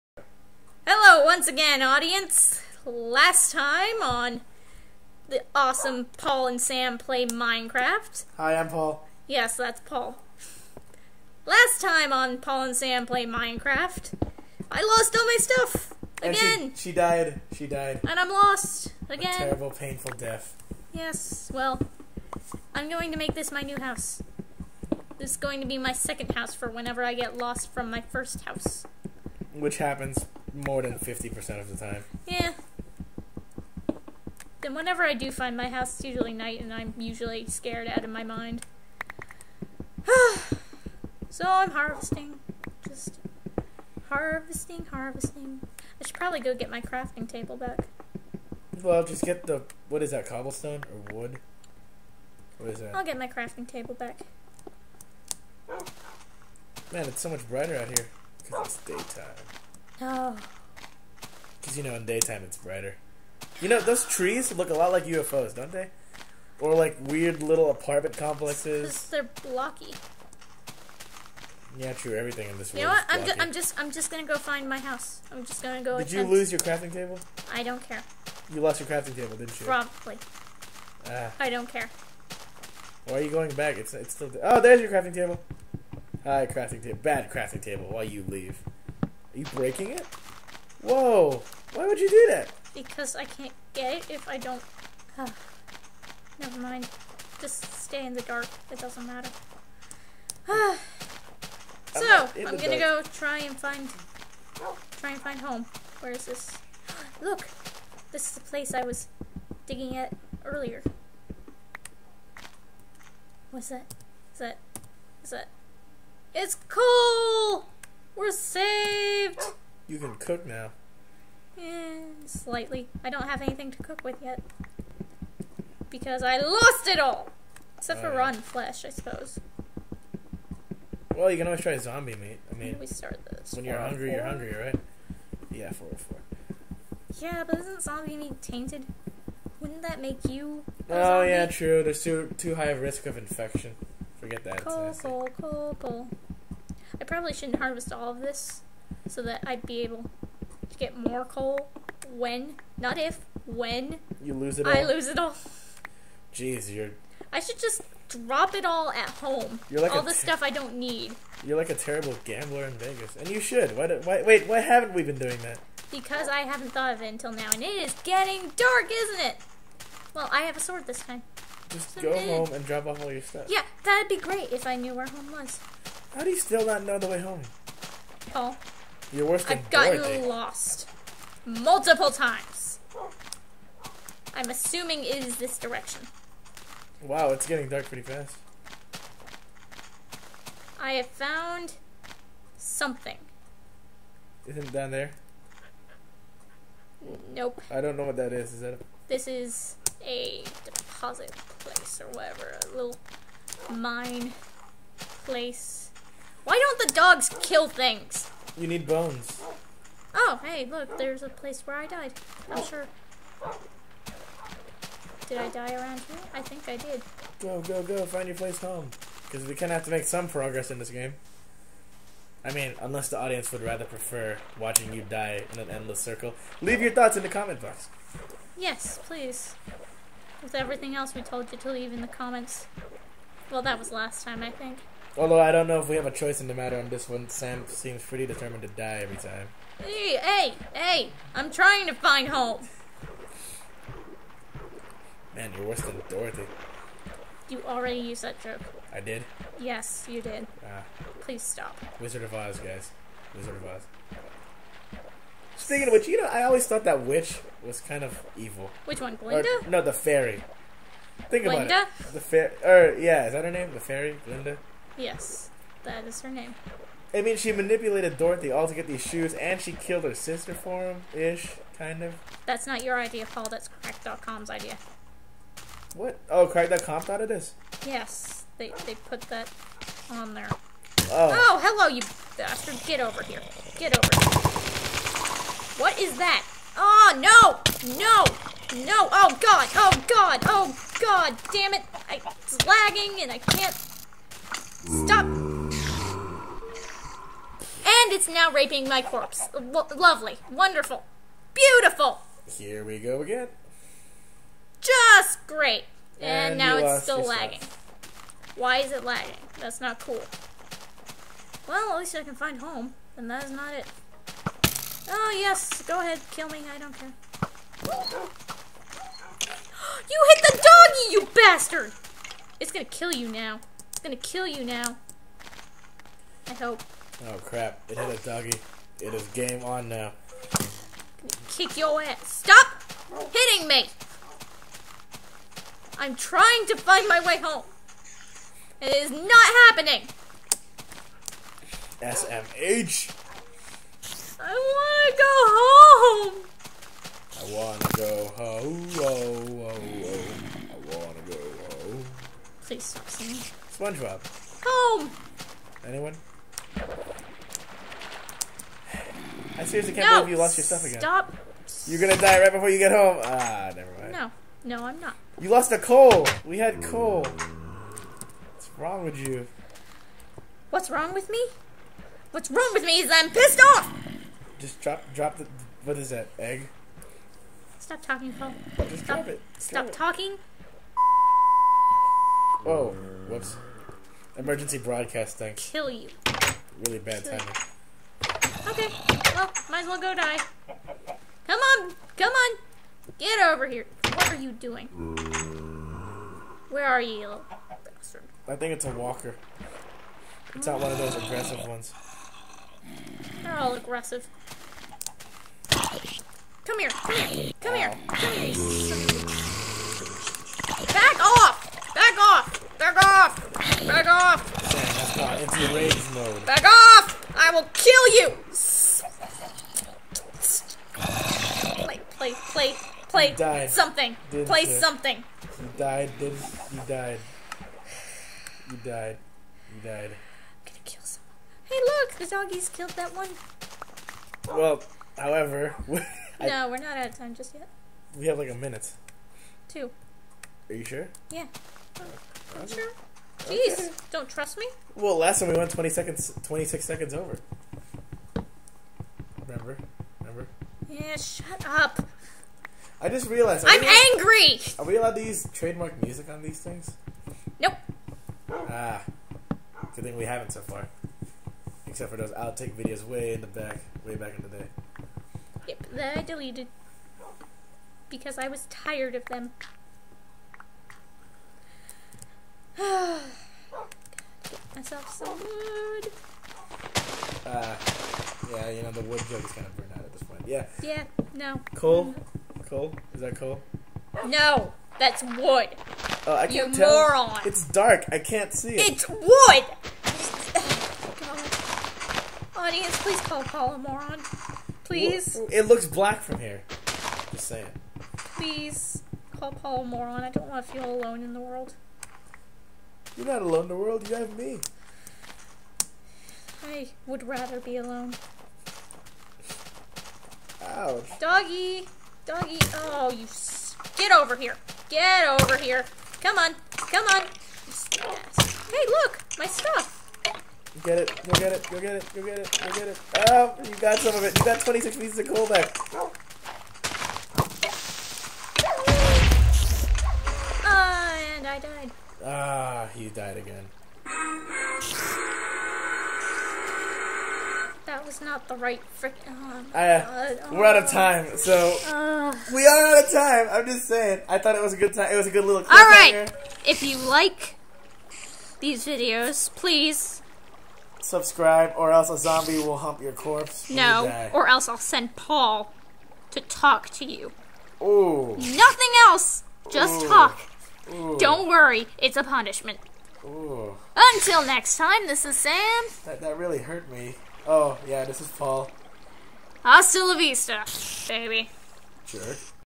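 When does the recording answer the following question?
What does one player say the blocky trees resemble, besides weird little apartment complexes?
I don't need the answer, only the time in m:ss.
1:05.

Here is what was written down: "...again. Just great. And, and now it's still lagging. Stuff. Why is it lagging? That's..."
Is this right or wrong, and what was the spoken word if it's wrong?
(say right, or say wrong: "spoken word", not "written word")
right.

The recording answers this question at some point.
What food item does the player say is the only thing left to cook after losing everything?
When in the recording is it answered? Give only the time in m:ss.
2:08.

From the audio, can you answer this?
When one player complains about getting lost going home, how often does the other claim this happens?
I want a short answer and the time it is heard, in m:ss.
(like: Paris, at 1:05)
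More than 50% of the time, at 0:30.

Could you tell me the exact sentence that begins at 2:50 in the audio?
Well, I have a sword this time.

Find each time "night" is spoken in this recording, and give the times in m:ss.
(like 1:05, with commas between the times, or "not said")
0:36.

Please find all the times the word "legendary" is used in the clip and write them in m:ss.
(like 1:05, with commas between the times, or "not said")
not said.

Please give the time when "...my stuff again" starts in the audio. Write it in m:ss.
0:15.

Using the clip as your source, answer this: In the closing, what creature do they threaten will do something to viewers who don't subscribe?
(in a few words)
A zombie.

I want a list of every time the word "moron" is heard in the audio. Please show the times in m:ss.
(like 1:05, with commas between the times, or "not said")
8:07, 8:13, 8:19.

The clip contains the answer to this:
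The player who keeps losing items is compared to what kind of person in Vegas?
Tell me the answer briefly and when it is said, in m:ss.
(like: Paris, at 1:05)
A terrible gambler, at 2:41.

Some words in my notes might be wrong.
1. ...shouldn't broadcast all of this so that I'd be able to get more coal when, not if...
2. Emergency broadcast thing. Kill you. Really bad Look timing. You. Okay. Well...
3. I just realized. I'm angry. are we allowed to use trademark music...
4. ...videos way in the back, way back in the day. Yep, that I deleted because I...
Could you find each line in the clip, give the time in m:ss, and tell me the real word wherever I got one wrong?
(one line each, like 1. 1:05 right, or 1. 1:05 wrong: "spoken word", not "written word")
1. 2:27 wrong: "harvest", not "broadcast"
2. 6:24 wrong: "Kill", not "Look"
3. 7:33 right
4. 7:42 right.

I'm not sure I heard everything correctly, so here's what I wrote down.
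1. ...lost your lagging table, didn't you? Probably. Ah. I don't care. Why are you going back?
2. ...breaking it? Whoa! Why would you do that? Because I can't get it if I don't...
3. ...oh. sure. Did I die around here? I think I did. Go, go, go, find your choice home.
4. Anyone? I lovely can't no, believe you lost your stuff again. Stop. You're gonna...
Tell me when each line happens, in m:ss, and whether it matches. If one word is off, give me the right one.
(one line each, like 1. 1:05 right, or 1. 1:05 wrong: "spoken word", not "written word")
1. 1:18 wrong: "crafting", not "lagging"
2. 1:29 right
3. 3:32 wrong: "place", not "choice"
4. 5:55 wrong: "seriously", not "lovely".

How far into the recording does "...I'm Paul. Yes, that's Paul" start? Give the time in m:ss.
0:08.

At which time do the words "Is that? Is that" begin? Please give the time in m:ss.
1:54.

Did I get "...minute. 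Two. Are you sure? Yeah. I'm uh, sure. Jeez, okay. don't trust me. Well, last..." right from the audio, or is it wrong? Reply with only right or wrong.
right.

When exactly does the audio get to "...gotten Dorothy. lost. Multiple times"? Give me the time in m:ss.
2:59.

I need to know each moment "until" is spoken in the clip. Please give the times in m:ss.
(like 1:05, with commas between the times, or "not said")
2:47, 9:23.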